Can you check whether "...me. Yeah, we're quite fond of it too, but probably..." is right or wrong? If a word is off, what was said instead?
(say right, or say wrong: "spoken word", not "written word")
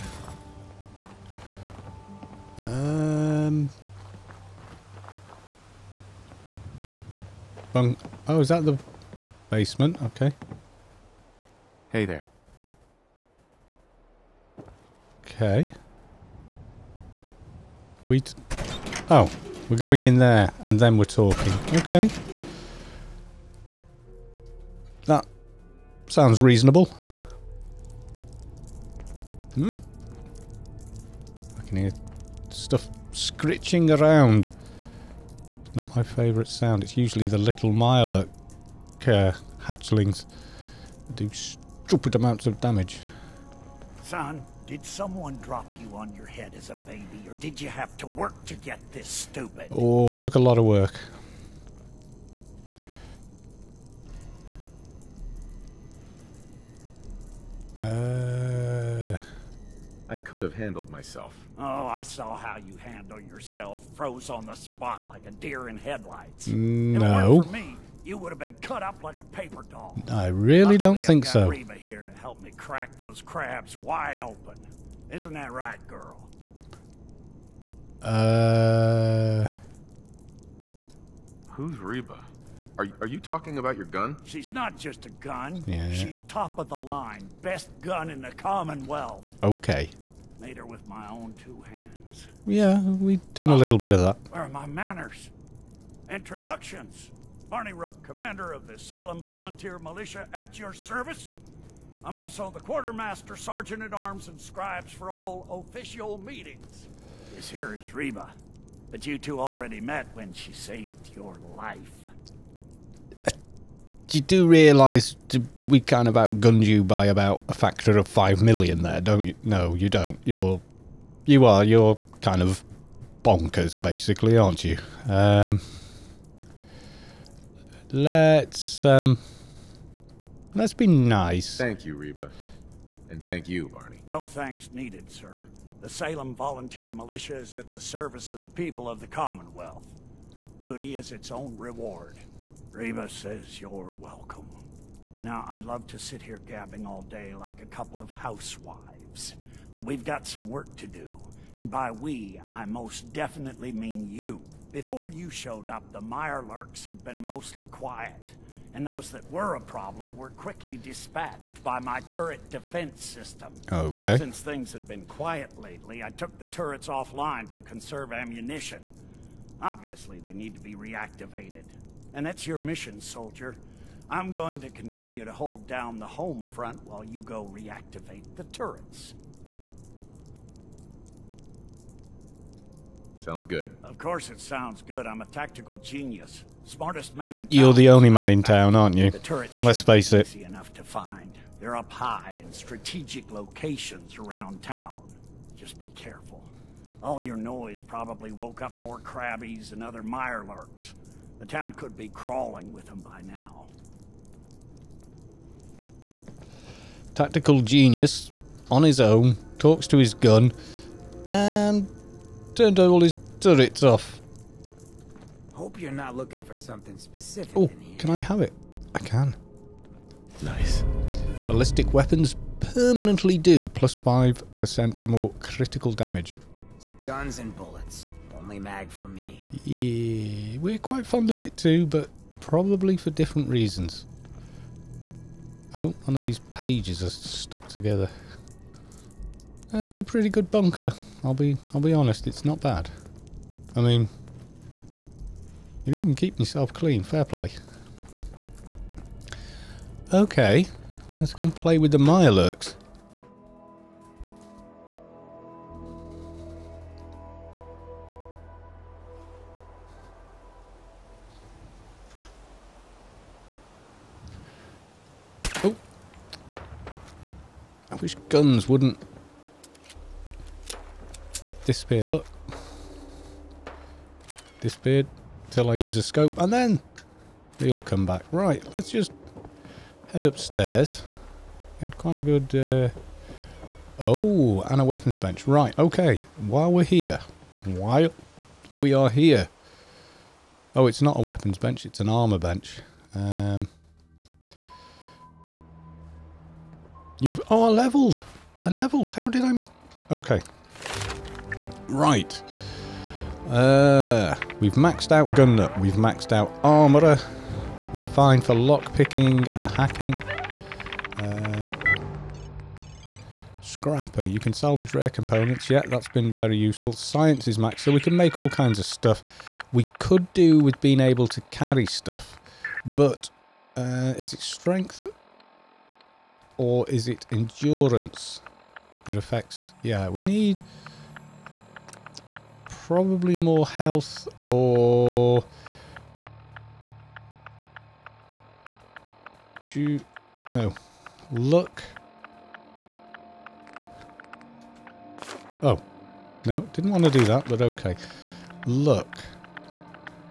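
right.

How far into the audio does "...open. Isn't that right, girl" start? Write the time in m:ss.
1:14.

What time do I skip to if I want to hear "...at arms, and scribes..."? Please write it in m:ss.
1:43.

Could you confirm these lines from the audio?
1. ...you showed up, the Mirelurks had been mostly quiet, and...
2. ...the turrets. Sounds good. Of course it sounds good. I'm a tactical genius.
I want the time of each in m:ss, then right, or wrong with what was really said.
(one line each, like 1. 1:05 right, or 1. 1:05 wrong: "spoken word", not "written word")
1. 2:35 right
2. 2:58 right.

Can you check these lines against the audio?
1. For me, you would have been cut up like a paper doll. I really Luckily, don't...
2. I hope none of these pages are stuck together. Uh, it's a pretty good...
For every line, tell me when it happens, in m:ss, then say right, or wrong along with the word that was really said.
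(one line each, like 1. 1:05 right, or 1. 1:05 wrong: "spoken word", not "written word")
1. 1:07 right
2. 3:55 right.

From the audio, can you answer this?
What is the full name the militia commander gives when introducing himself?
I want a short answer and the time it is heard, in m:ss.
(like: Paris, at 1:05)
Barney Rook, at 1:37.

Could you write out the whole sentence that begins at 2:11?
Thank you, Reba, and thank you, Barney.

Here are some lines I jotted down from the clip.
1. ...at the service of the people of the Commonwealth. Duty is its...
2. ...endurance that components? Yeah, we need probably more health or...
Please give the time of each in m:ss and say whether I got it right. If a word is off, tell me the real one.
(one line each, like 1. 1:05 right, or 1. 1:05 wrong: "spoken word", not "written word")
1. 2:17 right
2. 5:27 wrong: "affects", not "components".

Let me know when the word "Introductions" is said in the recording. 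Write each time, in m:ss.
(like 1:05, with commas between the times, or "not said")
1:36.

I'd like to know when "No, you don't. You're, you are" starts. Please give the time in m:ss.
1:59.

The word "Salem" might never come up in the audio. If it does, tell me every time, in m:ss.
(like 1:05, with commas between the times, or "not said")
1:38, 2:15.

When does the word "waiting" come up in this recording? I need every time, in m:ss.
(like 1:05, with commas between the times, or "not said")
not said.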